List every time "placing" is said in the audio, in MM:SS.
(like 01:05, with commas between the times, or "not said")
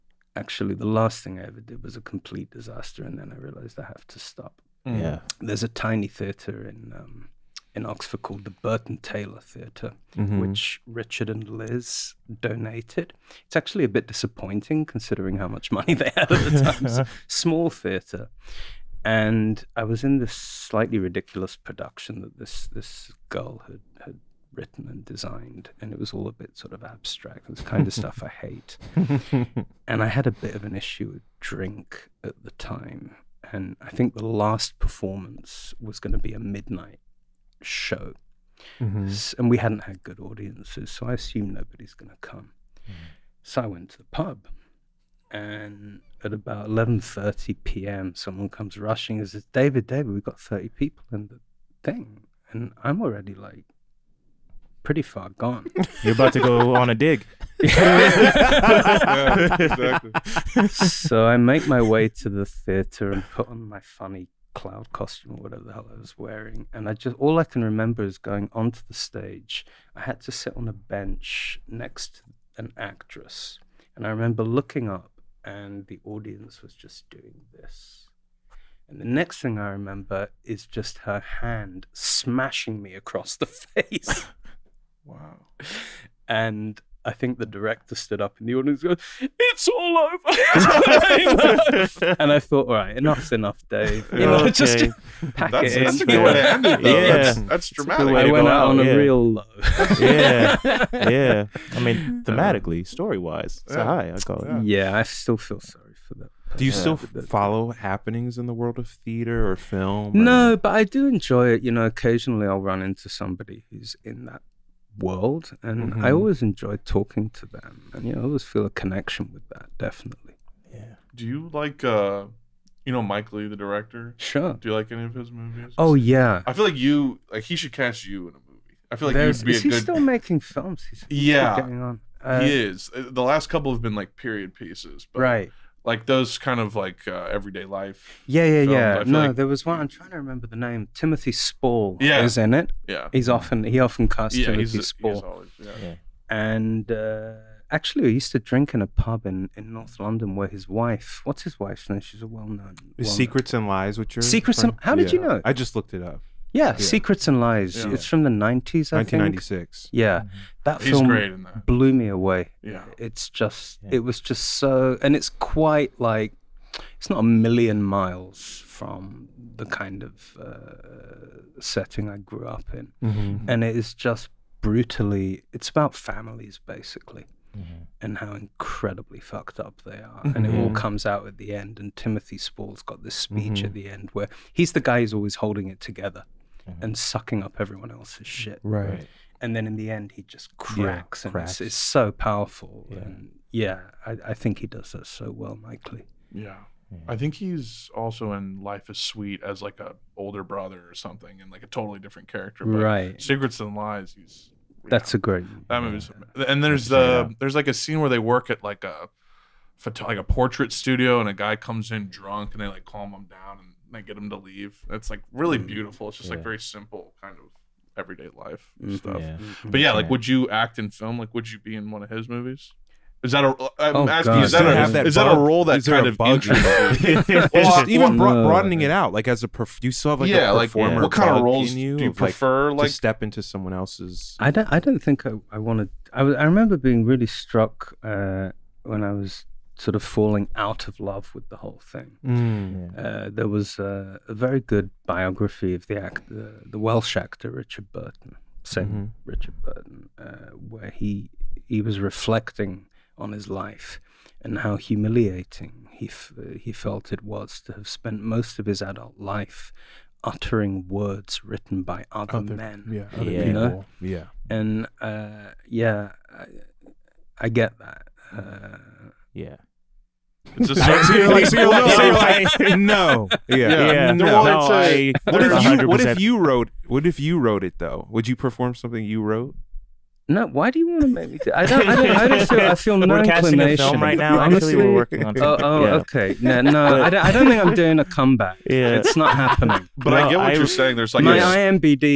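not said.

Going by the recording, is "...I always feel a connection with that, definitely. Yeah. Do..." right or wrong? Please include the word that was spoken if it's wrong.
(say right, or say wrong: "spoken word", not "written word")
right.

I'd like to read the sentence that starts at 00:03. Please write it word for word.
And then I realized I have to stop.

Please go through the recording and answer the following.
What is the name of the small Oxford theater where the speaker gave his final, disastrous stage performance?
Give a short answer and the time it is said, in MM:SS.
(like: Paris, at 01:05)
Burton Taylor theater, at 00:08.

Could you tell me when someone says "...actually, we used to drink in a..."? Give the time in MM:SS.
02:27.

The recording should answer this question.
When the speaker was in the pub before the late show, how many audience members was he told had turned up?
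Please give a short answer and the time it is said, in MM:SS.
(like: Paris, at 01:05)
30, at 00:50.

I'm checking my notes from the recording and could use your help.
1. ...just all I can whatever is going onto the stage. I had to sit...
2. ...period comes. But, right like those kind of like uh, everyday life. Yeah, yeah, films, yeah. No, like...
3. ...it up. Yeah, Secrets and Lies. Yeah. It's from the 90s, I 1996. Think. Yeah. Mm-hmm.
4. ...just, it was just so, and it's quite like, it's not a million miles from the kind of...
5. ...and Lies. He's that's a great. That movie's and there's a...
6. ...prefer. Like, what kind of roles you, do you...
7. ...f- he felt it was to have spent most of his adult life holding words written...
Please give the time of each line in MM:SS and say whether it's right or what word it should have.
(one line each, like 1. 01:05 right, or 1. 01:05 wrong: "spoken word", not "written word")
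1. 01:06 wrong: "remember", not "whatever"
2. 02:14 wrong: "pieces", not "comes"
3. 02:35 right
4. 02:43 right
5. 03:23 right
6. 03:50 wrong: "performer", not "prefer"
7. 04:16 wrong: "uttering", not "holding".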